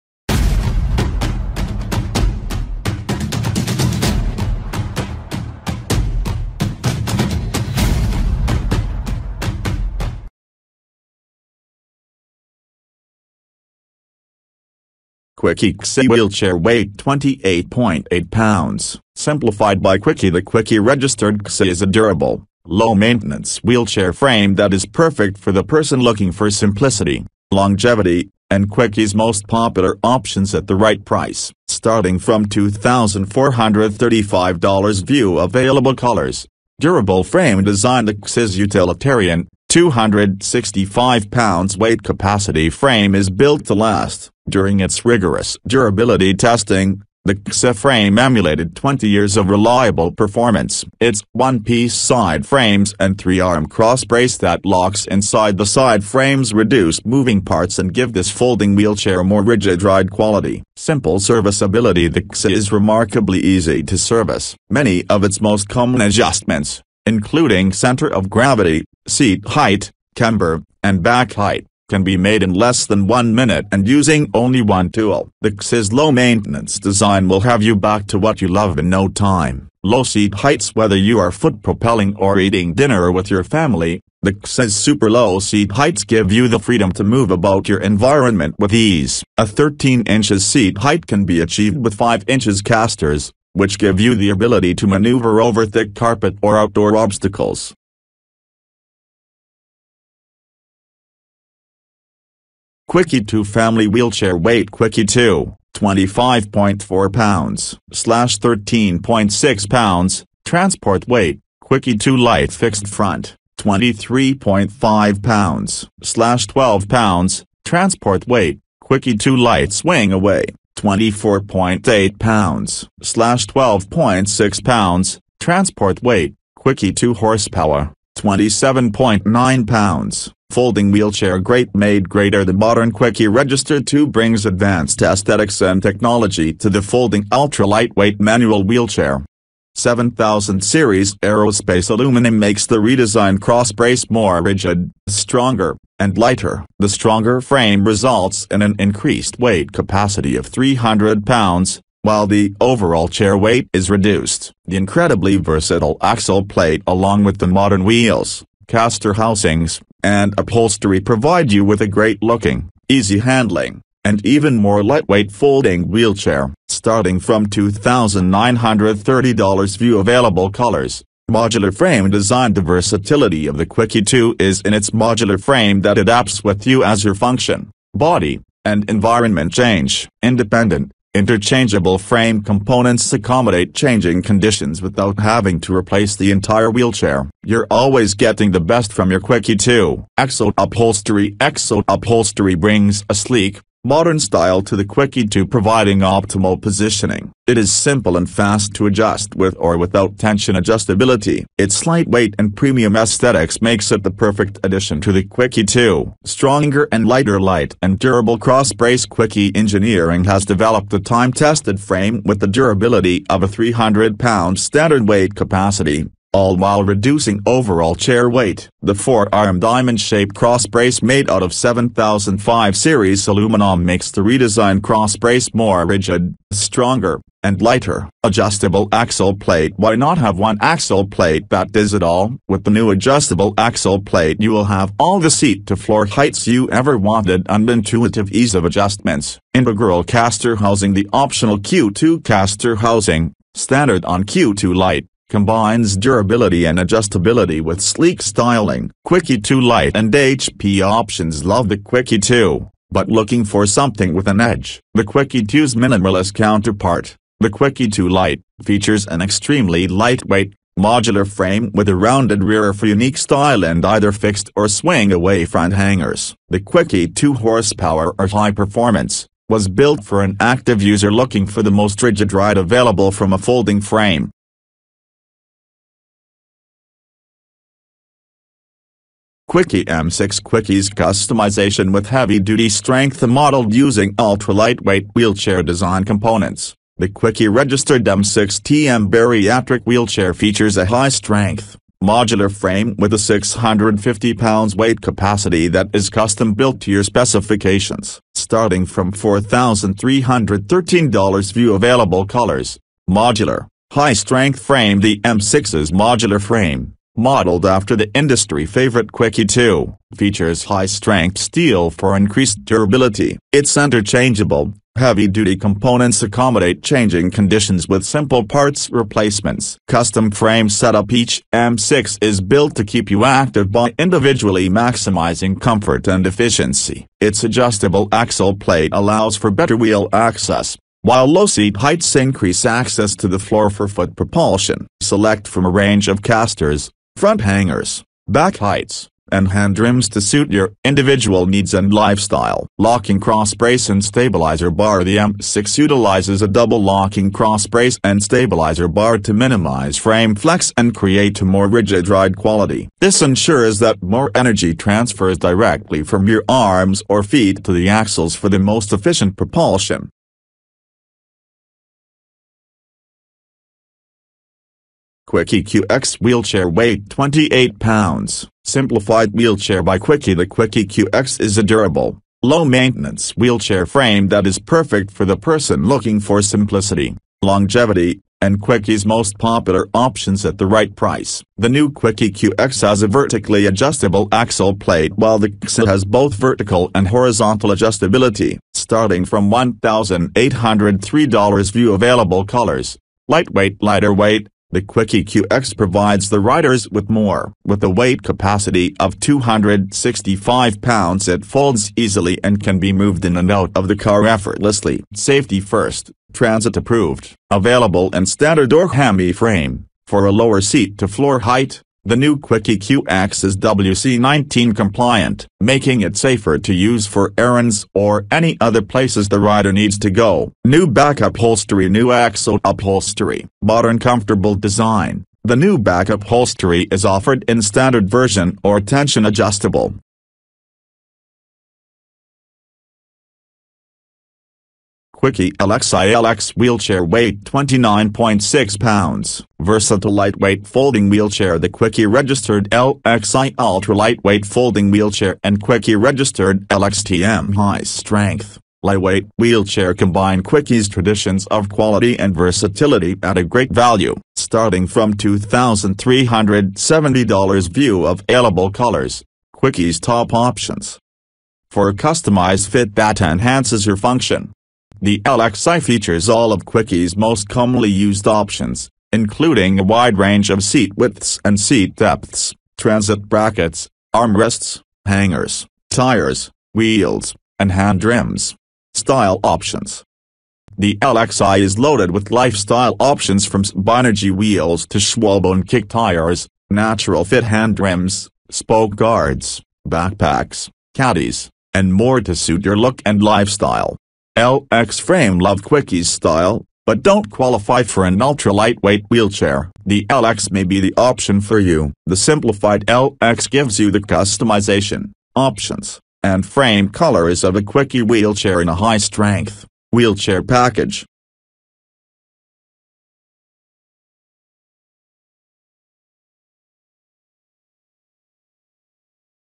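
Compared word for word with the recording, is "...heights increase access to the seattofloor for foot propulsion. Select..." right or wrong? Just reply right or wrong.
wrong.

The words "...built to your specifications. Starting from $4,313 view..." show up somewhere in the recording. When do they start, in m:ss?
4:56.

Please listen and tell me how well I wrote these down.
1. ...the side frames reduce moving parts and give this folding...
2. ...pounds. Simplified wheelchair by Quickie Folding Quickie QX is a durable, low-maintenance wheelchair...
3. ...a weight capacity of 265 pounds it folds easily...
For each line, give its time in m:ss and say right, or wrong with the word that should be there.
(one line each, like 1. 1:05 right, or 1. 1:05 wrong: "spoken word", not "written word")
1. 0:55 right
2. 6:07 wrong: "The", not "Folding"
3. 6:37 right.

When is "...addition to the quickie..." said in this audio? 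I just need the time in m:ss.
3:24.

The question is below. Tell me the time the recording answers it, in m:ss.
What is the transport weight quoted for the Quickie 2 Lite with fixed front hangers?
1:56.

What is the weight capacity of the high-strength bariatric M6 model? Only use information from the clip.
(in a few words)
650 pounds.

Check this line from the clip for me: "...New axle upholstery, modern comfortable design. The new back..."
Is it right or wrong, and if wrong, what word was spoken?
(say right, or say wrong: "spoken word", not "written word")
right.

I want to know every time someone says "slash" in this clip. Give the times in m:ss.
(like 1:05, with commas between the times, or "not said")
1:47, 1:56, 2:03.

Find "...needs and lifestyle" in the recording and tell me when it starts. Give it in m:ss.
5:41.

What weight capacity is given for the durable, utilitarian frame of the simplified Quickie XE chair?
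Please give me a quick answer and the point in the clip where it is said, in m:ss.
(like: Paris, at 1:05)
265 pounds, at 0:39.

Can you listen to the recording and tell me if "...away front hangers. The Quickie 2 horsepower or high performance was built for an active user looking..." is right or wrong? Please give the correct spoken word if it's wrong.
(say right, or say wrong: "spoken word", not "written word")
right.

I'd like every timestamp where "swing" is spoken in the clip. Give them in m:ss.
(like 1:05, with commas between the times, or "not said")
1:59, 4:24.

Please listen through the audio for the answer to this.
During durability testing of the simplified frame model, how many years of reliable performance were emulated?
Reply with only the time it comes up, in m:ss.
0:48.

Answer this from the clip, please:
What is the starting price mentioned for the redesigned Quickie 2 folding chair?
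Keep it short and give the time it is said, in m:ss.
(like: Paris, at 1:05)
$2,930, at 2:47.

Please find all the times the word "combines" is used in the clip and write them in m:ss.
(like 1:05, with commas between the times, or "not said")
4:05, 7:29.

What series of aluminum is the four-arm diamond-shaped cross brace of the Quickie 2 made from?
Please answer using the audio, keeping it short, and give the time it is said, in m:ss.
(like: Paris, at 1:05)
7005 series, at 3:41.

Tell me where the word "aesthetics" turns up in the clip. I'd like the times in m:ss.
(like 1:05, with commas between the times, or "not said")
2:15, 3:22.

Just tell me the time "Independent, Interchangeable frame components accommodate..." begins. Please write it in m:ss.
3:00.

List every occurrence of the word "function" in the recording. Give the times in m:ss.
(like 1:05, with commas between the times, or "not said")
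2:57, 7:43.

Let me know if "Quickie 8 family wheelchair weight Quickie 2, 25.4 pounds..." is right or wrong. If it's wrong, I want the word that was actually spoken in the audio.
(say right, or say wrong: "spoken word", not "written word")
wrong: "2", not "8".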